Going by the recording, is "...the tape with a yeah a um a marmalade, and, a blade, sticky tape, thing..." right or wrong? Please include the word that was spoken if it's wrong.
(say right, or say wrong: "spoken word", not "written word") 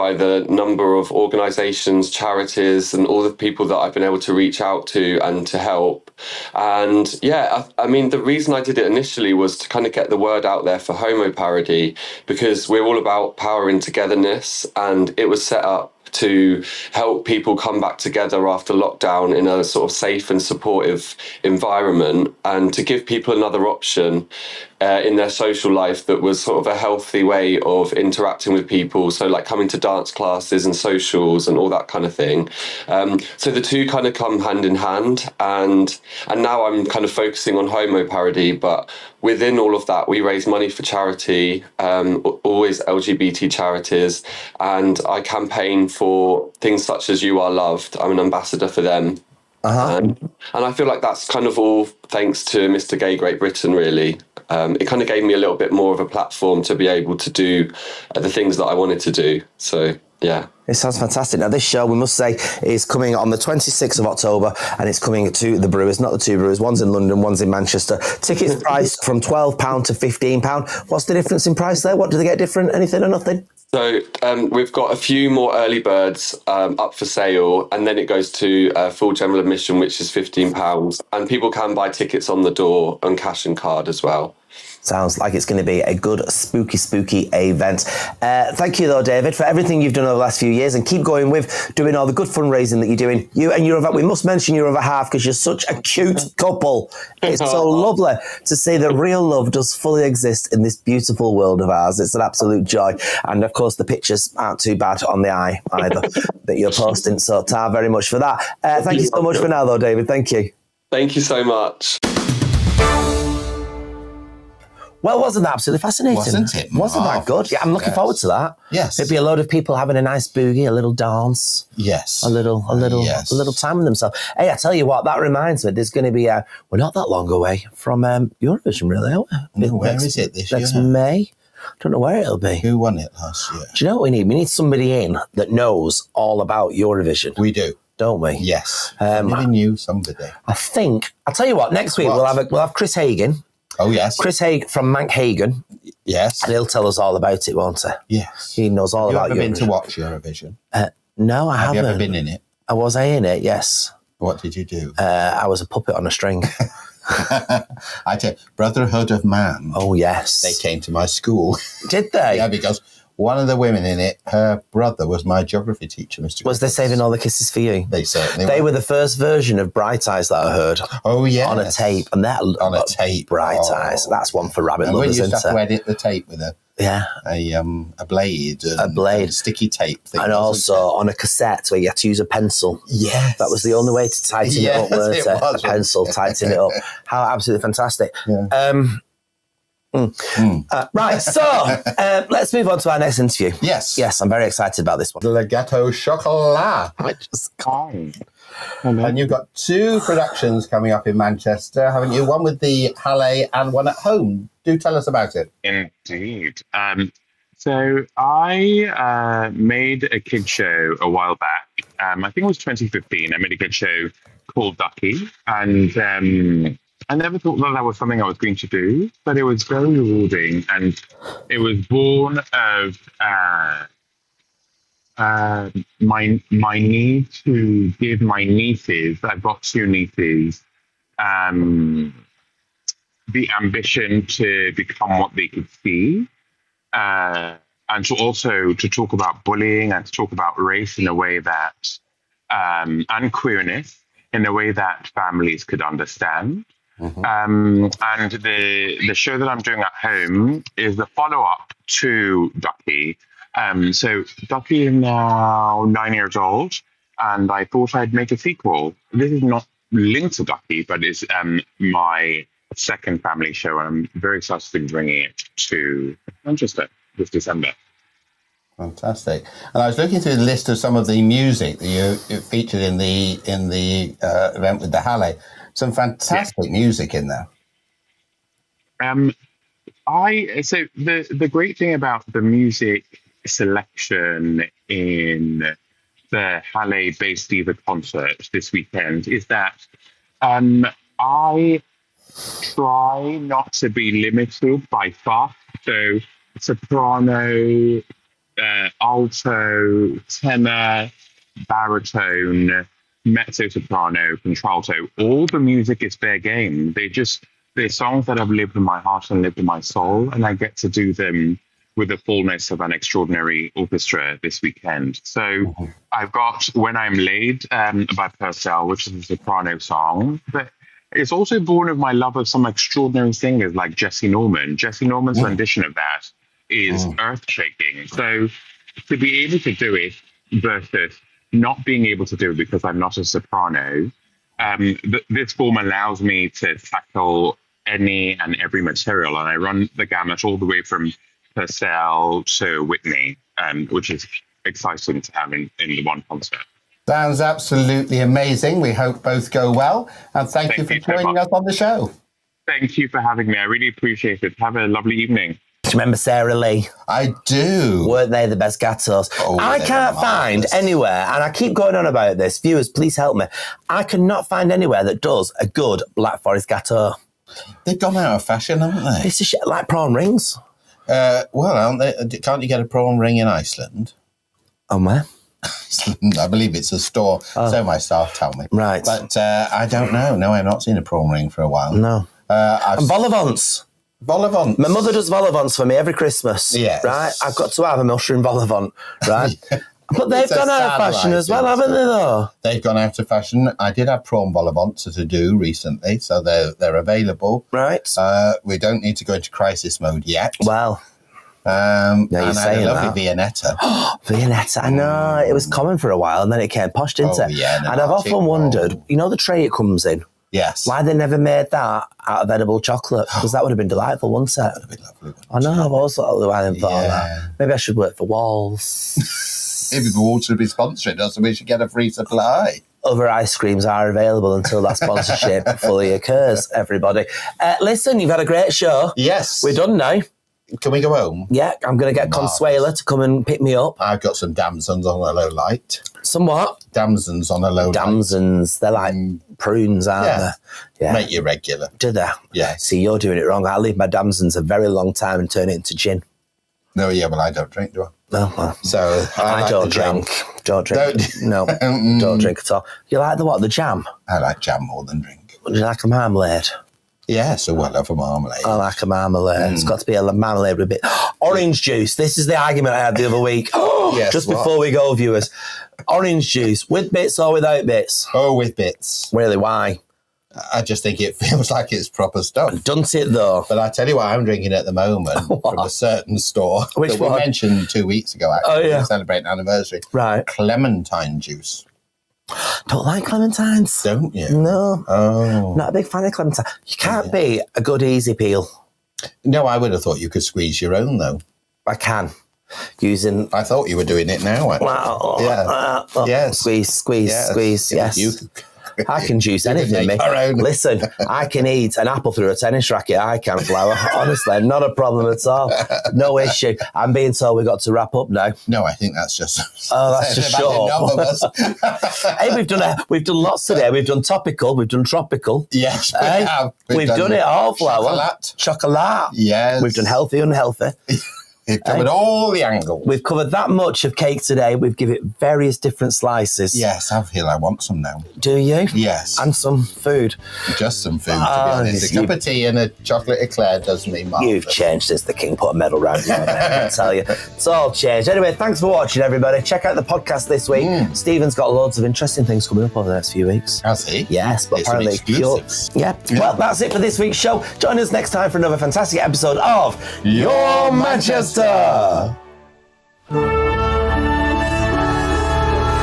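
wrong: "blade", not "marmalade".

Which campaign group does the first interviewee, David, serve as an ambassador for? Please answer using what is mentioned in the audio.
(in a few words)
You Are Loved.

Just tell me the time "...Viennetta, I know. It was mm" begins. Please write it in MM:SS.
06:44.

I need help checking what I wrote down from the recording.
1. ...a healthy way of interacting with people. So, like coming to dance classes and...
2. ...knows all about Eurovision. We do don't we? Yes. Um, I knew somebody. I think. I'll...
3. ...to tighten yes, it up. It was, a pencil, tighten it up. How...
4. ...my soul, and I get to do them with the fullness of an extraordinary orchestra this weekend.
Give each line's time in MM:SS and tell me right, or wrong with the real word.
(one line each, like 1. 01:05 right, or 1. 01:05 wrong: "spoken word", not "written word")
1. 00:26 right
2. 02:15 right
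3. 03:04 right
4. 05:09 right.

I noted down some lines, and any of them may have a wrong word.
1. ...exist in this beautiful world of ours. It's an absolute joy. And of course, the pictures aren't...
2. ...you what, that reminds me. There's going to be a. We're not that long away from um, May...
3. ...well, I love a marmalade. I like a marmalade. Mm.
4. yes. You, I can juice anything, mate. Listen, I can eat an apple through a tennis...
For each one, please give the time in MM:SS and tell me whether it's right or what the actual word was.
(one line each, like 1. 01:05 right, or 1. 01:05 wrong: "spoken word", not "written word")
1. 01:40 right
2. 02:04 wrong: "Eurovision", not "May"
3. 07:37 right
4. 08:18 right.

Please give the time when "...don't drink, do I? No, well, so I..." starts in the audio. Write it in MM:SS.
07:27.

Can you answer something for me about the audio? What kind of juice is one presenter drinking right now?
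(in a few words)
Clementine juice.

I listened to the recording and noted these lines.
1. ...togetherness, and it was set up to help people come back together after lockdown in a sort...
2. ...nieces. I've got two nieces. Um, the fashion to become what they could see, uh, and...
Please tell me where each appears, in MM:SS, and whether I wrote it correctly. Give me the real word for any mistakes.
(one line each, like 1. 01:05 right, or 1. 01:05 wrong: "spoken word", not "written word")
1. 00:13 right
2. 03:48 wrong: "ambition", not "fashion".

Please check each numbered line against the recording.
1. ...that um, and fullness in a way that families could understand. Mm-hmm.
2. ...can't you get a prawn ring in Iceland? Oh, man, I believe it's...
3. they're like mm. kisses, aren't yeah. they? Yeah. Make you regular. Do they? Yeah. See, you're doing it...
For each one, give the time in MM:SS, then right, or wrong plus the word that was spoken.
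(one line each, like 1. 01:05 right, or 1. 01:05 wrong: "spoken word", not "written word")
1. 04:01 wrong: "queerness", not "fullness"
2. 06:12 right
3. 07:18 wrong: "prunes", not "kisses".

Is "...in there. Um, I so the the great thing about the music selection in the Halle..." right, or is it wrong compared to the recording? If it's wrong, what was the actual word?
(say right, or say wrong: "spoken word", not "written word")
right.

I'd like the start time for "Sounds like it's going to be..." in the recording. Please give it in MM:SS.
01:24.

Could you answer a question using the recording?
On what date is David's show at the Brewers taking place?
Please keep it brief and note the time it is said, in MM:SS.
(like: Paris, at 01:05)
26th of October, at 01:03.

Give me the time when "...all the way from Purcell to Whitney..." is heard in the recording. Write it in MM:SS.
05:40.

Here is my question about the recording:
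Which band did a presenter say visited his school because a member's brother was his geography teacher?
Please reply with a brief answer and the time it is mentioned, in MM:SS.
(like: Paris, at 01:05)
Brotherhood of Man, at 02:38.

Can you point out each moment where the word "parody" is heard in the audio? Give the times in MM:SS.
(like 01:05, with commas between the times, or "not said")
00:11, 00:38.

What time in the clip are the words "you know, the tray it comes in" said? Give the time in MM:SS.
06:49.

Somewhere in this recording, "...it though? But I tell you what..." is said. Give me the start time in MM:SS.
07:53.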